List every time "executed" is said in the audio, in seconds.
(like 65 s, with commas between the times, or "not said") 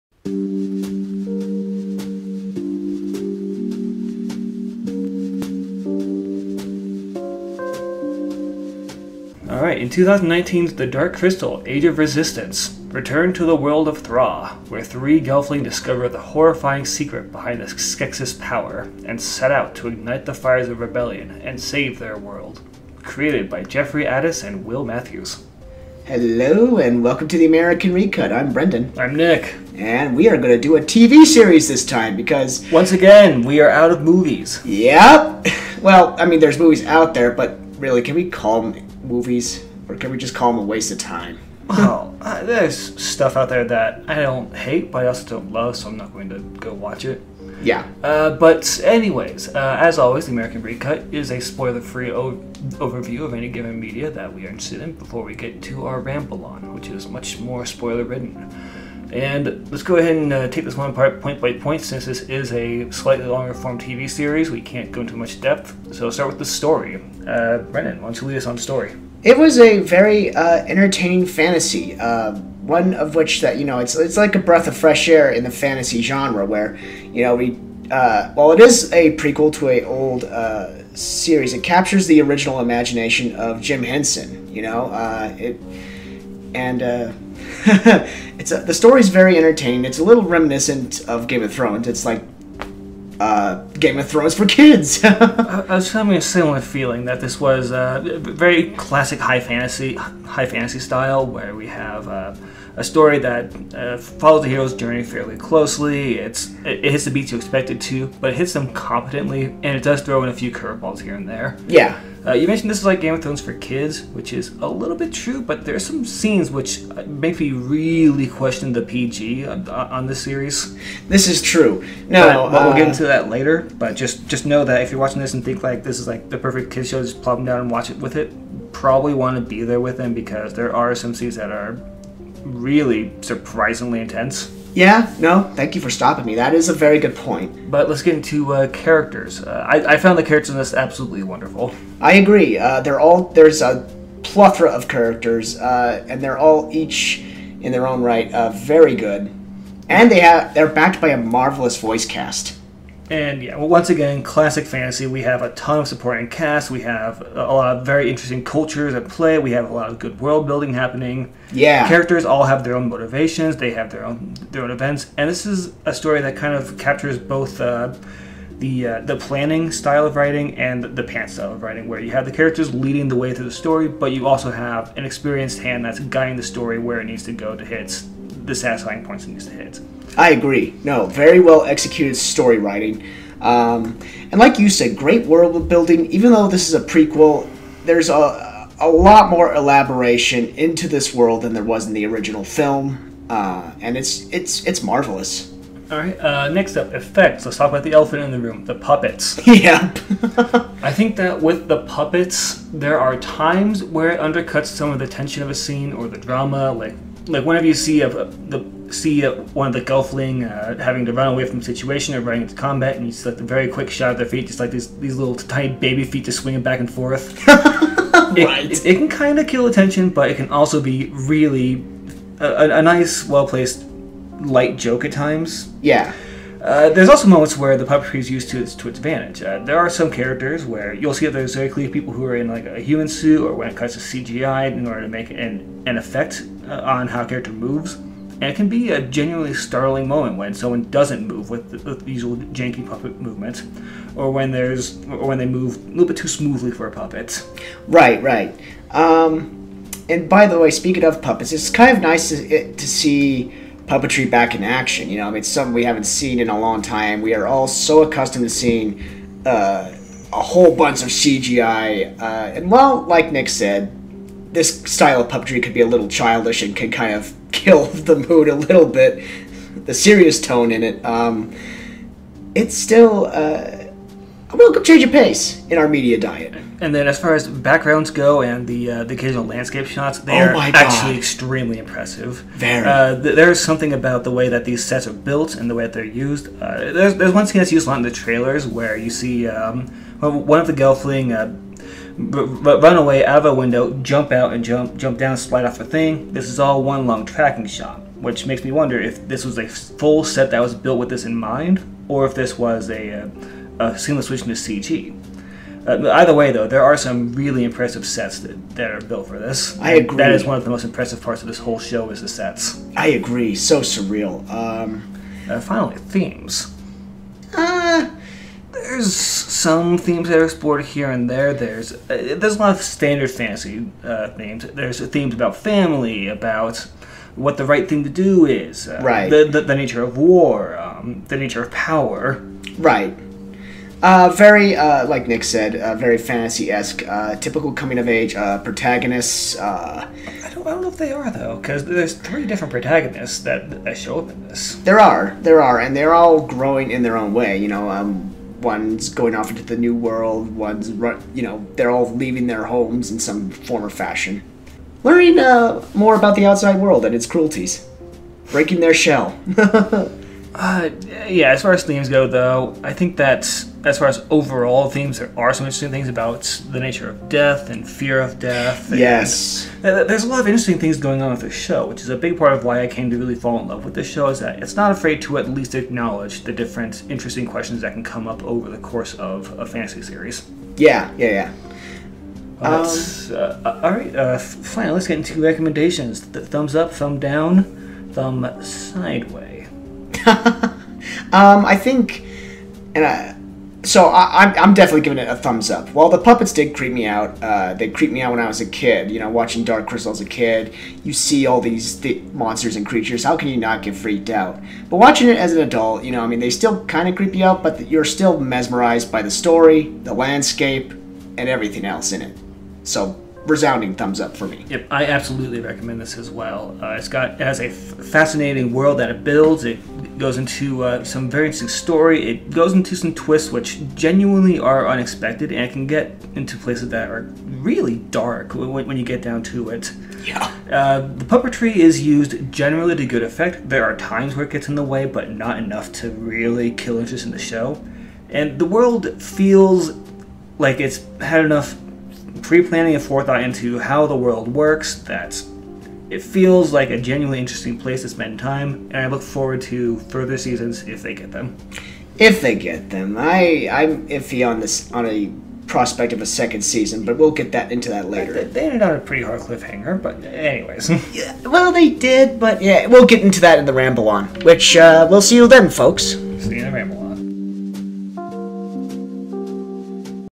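181 s.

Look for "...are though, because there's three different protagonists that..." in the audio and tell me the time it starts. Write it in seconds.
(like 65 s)
341 s.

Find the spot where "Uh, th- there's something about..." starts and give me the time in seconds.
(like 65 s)
282 s.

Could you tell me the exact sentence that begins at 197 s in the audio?
Let's talk about the elephant in the room: the puppets.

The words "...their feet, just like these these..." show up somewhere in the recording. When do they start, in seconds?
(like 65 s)
214 s.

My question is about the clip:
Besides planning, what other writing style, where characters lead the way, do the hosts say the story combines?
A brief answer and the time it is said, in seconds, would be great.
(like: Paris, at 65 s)
pants style, at 171 s.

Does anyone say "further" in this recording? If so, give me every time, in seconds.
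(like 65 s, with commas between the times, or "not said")
450 s.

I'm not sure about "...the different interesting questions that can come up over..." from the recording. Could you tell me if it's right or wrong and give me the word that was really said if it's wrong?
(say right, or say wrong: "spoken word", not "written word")
right.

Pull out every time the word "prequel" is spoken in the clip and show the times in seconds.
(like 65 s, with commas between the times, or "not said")
79 s, 186 s.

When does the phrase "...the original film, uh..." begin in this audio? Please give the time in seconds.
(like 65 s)
191 s.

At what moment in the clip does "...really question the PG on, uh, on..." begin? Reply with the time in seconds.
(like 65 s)
117 s.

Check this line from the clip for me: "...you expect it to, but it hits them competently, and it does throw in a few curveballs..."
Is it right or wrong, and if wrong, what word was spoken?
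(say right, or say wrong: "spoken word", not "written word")
right.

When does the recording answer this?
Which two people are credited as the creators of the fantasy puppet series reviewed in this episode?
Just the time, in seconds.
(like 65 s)
23 s.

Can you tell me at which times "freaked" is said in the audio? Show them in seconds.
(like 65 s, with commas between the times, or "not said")
403 s.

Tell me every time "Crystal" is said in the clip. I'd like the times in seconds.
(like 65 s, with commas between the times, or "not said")
11 s, 399 s.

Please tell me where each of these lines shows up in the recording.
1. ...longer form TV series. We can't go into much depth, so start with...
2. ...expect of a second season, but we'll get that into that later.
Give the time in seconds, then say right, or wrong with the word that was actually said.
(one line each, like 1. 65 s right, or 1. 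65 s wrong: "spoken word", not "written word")
1. 63 s right
2. 455 s wrong: "prospect", not "expect".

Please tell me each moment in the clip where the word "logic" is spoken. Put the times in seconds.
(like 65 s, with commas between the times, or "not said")
not said.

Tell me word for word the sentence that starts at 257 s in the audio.
We are all so accustomed to seeing uh, a whole bunch of CGI.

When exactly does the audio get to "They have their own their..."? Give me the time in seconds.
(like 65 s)
163 s.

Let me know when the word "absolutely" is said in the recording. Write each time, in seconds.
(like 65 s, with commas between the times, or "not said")
140 s, 415 s.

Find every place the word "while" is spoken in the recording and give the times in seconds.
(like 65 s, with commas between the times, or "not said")
78 s, 395 s.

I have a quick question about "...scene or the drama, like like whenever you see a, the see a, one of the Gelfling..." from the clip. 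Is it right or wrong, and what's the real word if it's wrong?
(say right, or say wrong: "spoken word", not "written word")
right.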